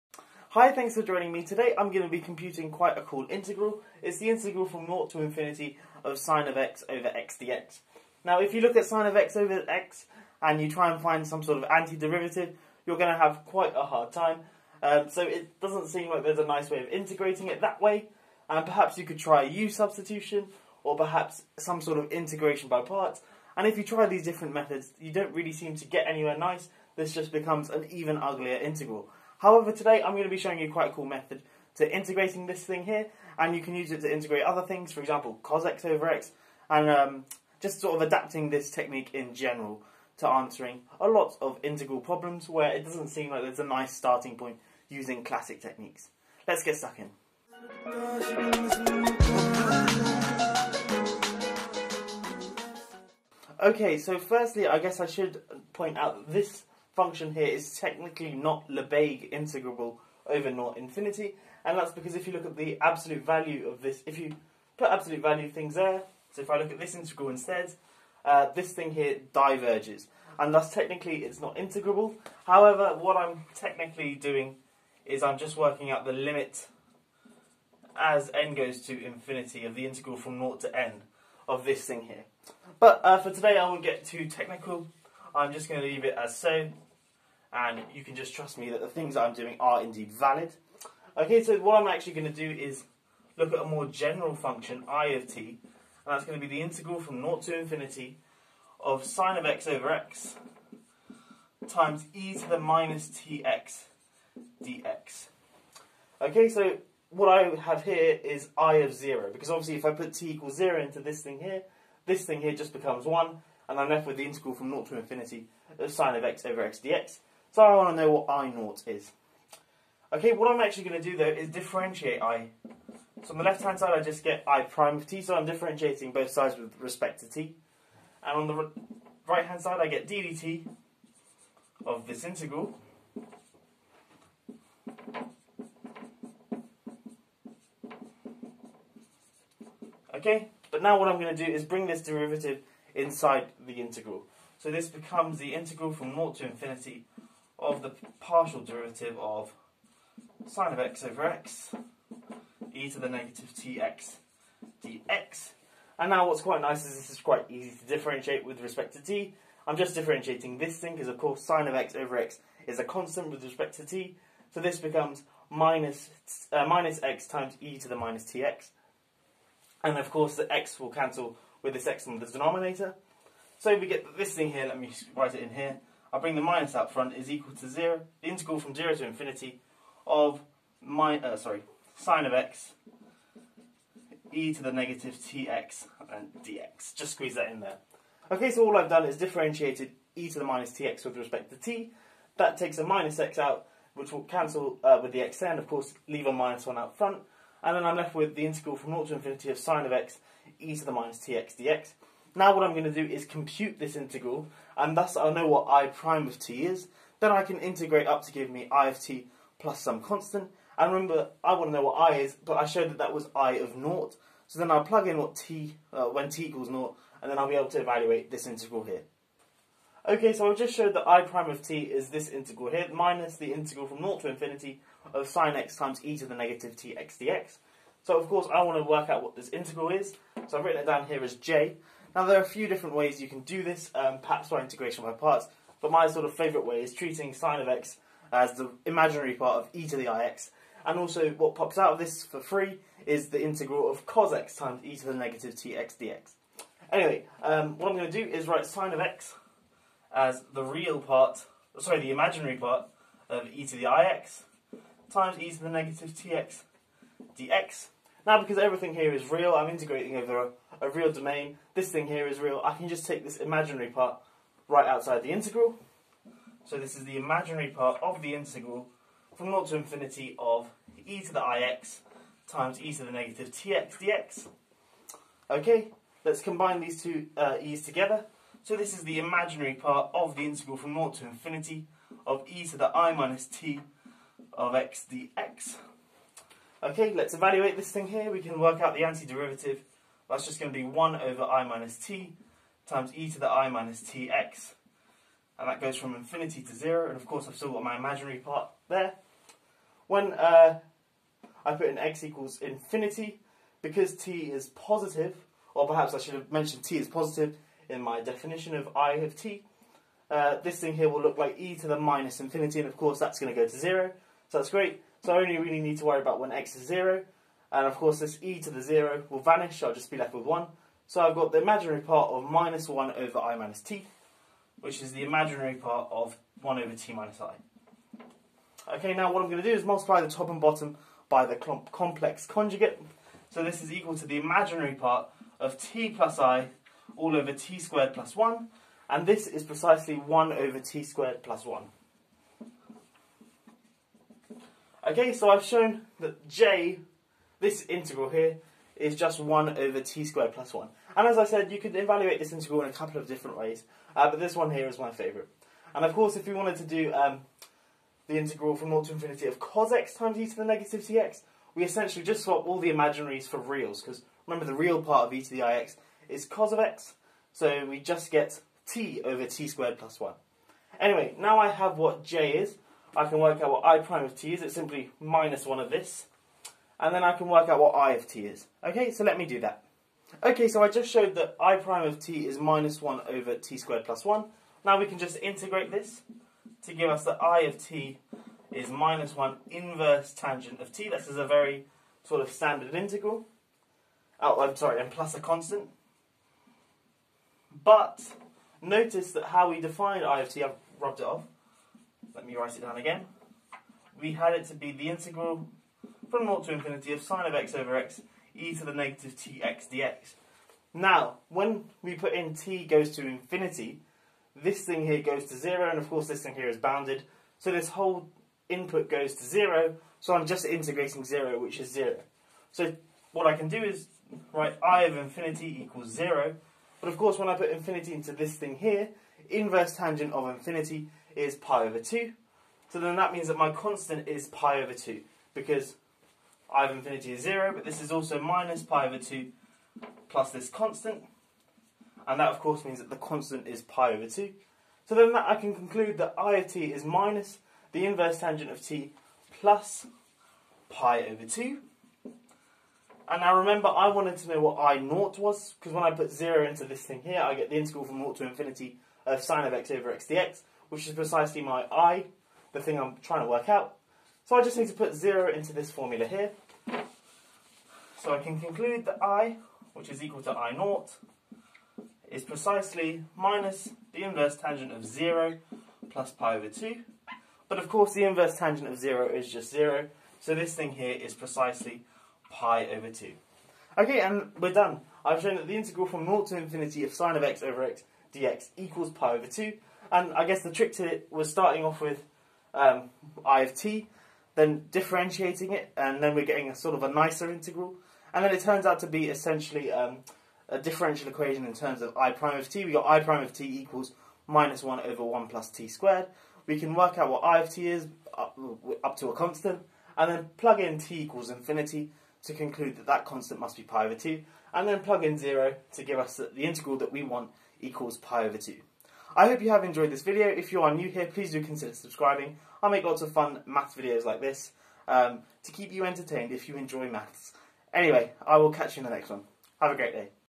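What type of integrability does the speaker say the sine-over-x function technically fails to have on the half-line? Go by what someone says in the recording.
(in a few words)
Lebesgue integrable.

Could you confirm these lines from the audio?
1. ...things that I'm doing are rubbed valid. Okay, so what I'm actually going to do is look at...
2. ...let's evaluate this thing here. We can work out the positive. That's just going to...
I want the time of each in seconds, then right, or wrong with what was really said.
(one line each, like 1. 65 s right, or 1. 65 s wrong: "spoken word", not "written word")
1. 88 s wrong: "indeed", not "rubbed"
2. 287 s wrong: "antiderivative", not "positive".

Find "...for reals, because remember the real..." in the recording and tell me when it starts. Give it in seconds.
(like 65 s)
363 s.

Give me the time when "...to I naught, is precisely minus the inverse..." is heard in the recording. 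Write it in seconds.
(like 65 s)
470 s.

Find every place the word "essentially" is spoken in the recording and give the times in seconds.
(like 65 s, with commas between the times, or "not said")
361 s, 499 s.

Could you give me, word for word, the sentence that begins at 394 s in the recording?
Oh, I'm sorry, and plus a constant.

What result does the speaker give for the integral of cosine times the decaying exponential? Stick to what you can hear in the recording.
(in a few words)
t over t squared plus 1.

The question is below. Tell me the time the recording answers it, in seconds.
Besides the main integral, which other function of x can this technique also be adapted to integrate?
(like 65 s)
35 s.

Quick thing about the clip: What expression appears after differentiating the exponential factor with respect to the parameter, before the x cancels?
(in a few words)
minus x times e to the minus tx.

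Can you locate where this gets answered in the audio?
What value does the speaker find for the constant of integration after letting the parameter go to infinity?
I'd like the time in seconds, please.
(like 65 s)
443 s.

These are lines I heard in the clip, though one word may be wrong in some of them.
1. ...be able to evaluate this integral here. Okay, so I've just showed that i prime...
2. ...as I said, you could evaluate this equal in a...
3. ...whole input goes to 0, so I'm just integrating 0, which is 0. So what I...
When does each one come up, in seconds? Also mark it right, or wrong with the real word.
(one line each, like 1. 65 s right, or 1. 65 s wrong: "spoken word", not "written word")
1. 217 s right
2. 351 s wrong: "integral", not "equal"
3. 417 s right.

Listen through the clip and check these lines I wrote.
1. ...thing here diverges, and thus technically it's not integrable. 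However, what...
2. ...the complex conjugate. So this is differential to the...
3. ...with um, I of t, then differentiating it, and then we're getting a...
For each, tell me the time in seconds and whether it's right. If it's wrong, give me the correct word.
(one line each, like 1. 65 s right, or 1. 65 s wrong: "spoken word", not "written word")
1. 68 s right
2. 331 s wrong: "equal", not "differential"
3. 492 s right.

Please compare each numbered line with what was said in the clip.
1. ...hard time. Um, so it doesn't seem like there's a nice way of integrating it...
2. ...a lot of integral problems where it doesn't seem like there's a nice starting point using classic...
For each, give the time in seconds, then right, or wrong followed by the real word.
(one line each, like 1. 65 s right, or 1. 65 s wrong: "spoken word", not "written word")
1. 13 s right
2. 40 s right.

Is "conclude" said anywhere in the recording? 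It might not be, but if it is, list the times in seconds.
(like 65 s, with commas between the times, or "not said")
445 s, 468 s, 512 s.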